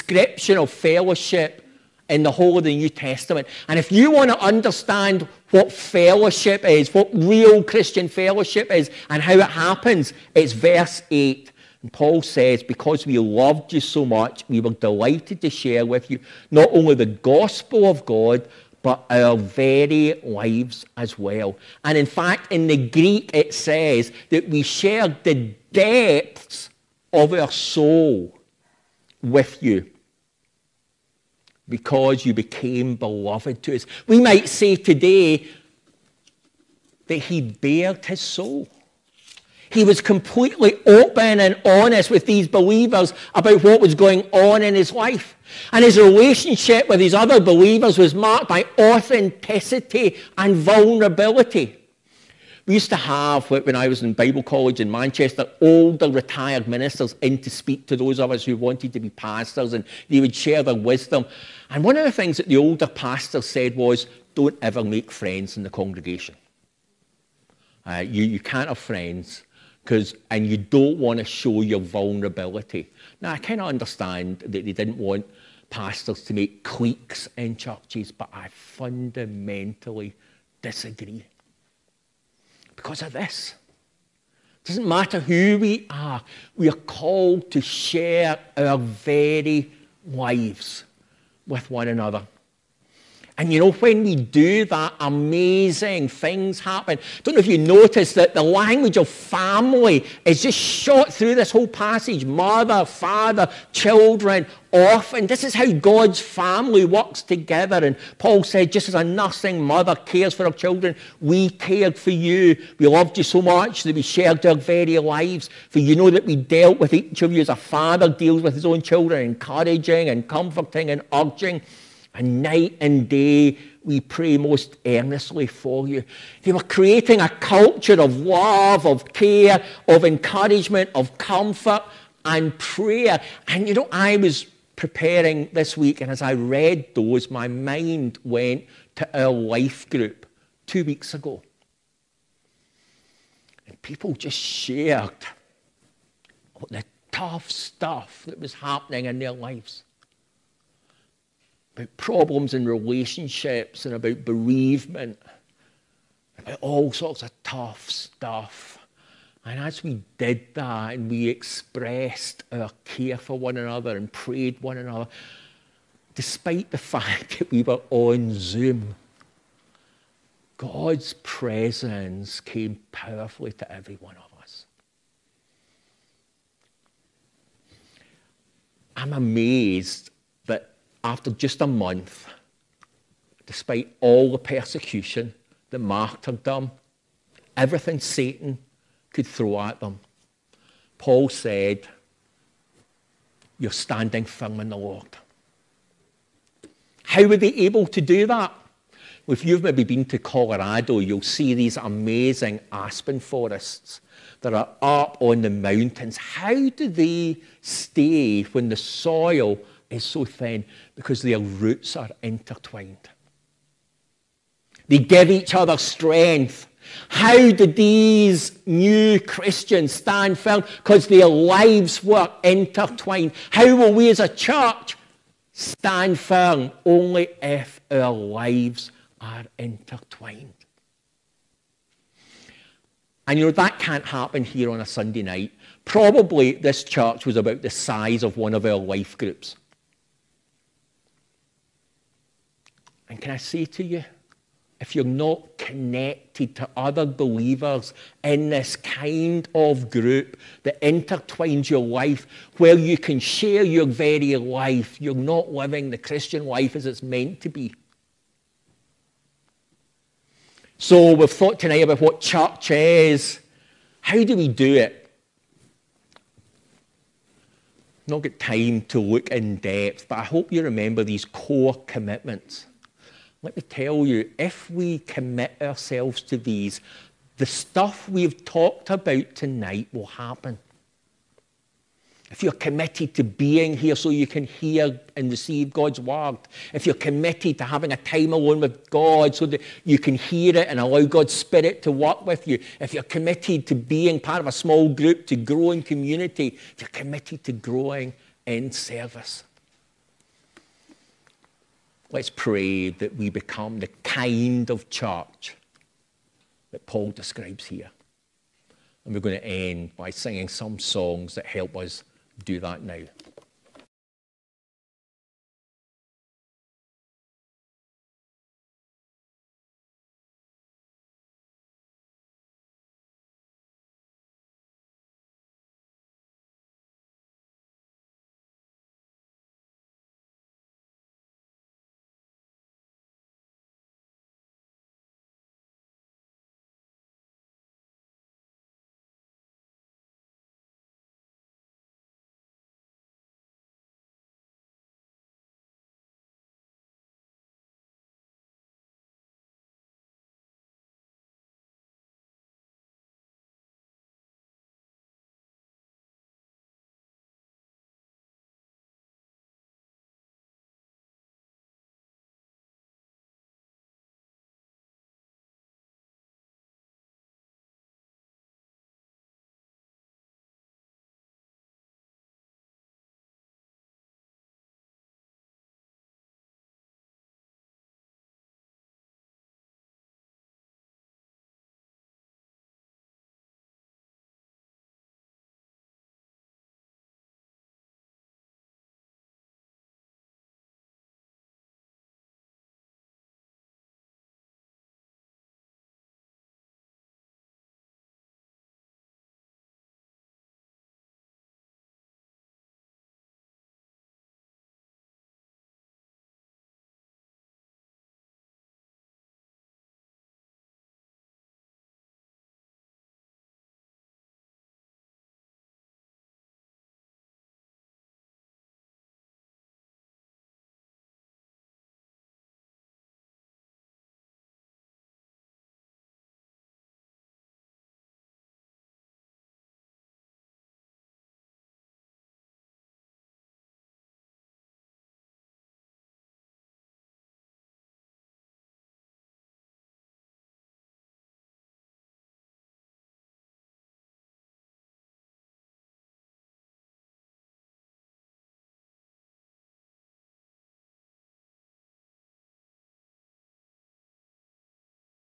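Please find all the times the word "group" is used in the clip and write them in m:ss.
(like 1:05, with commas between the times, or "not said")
2:19, 3:59, 4:09, 4:54.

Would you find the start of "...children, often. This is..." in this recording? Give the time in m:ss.
1:43.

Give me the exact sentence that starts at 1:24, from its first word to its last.
It doesn't matter who we are, we are called to share our very lives with one another.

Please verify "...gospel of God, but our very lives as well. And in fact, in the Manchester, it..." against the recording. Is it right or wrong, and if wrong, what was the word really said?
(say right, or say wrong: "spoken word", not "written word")
wrong: "Greek", not "Manchester".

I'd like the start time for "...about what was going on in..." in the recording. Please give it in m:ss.
0:43.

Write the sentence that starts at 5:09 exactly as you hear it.
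And we're going to end by singing some songs that help us do that now.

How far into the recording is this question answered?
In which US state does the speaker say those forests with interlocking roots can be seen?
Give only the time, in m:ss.
3:20.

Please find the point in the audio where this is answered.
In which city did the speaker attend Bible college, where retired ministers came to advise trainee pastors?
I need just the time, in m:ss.
0:54.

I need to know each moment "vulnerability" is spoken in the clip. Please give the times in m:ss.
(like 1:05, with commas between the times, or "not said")
0:50, 1:11.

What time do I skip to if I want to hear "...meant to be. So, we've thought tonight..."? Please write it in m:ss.
4:17.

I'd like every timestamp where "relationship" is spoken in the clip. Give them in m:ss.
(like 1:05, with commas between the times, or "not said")
0:45, 2:32.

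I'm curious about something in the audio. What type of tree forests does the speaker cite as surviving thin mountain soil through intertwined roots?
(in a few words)
Aspen.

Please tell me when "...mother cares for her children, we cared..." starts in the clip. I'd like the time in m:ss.
1:49.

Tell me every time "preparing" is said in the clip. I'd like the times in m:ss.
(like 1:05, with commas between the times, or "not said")
2:14.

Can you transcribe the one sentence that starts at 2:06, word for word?
They were creating a culture of love, of care, of encouragement, of comfort and prayer.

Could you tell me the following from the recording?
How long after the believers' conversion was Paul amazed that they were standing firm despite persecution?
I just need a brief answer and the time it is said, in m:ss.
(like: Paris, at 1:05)
A month, at 3:01.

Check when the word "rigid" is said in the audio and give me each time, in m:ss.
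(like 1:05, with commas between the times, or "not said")
not said.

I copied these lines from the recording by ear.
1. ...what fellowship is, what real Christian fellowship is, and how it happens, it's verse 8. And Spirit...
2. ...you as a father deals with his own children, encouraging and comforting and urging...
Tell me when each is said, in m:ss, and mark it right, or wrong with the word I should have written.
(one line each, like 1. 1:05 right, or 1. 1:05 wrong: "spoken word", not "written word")
1. 0:05 wrong: "Paul", not "Spirit"
2. 1:57 right.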